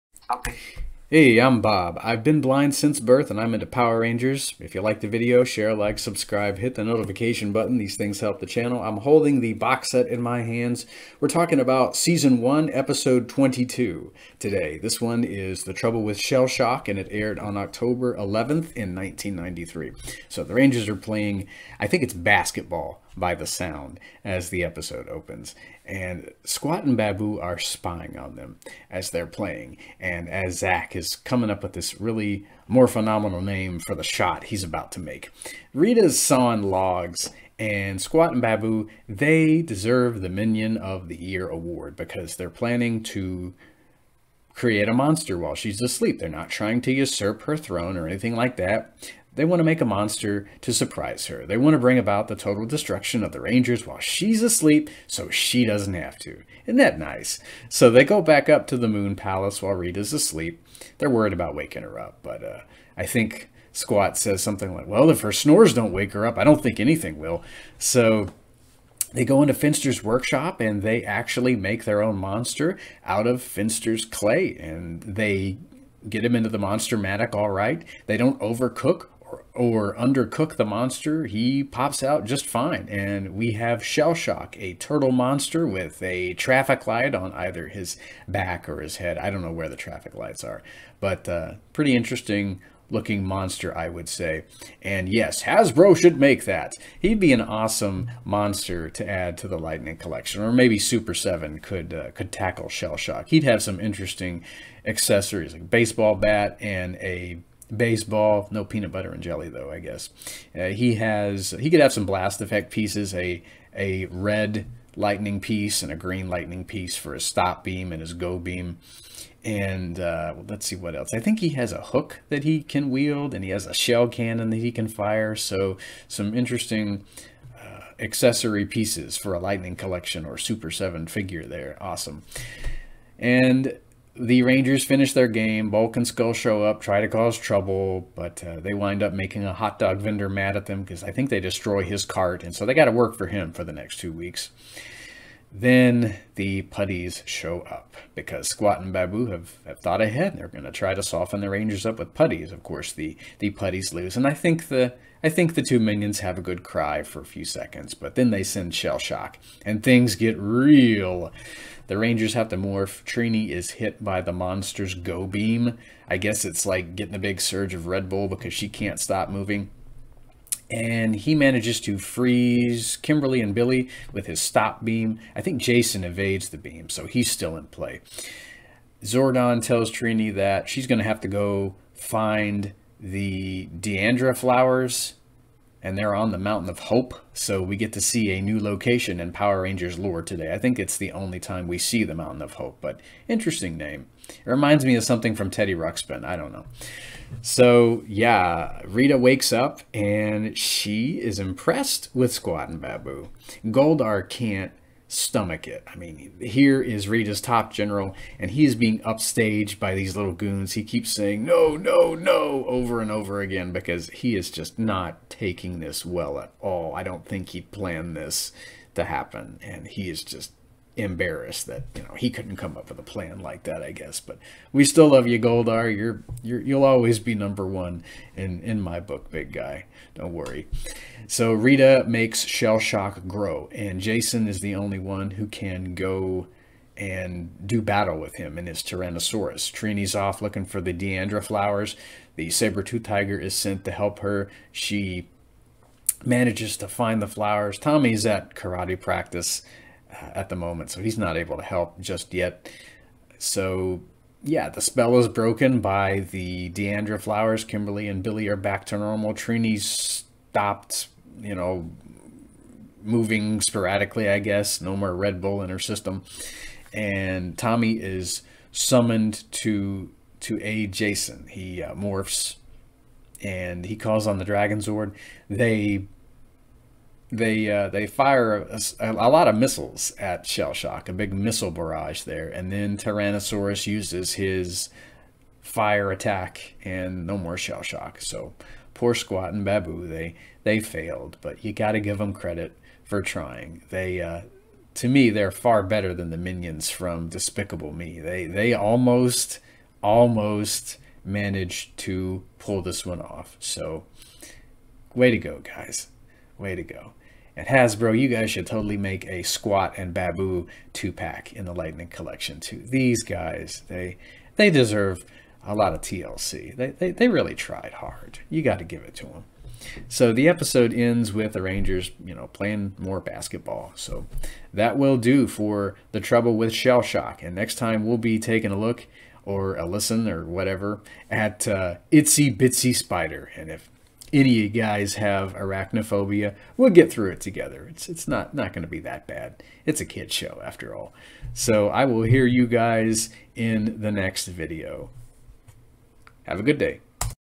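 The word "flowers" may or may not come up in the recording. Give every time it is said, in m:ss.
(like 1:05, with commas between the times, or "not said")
3:04, 4:01, 4:07, 4:17.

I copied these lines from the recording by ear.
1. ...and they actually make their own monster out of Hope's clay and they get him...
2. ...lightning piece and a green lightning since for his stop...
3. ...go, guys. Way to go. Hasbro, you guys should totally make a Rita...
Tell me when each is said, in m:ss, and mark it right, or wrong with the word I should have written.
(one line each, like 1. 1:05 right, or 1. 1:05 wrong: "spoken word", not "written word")
1. 1:10 wrong: "Finster", not "Hope"
2. 1:54 wrong: "piece", not "since"
3. 5:05 wrong: "Squatt", not "Rita".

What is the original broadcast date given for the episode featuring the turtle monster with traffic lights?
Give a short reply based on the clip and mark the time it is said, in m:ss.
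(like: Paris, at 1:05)
October 11th, 1993, at 0:17.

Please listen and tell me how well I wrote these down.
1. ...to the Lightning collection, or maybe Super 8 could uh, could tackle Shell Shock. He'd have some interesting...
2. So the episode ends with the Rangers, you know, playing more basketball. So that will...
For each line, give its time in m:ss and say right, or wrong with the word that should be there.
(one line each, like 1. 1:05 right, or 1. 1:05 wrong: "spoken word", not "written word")
1. 1:39 wrong: "7", not "8"
2. 5:20 right.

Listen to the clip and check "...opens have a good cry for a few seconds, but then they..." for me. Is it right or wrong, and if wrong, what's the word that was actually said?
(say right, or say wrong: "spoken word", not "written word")
wrong: "minions", not "opens".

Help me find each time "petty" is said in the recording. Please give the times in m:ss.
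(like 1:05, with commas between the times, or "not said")
not said.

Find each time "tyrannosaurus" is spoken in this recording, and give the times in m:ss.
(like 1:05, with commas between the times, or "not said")
3:58, 4:42.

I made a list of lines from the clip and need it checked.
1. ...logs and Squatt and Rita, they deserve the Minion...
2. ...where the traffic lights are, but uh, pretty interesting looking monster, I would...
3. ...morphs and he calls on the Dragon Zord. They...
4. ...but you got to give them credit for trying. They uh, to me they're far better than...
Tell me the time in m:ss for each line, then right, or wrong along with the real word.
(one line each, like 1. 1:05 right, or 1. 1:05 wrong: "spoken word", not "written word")
1. 0:36 wrong: "Baboo", not "Rita"
2. 1:29 right
3. 4:31 right
4. 4:51 right.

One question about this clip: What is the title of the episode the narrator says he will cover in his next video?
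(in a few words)
Itsy Bitsy Spider.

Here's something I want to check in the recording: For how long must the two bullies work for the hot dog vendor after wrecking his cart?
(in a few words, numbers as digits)
two weeks.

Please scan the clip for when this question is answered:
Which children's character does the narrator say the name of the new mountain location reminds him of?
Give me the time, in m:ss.
3:15.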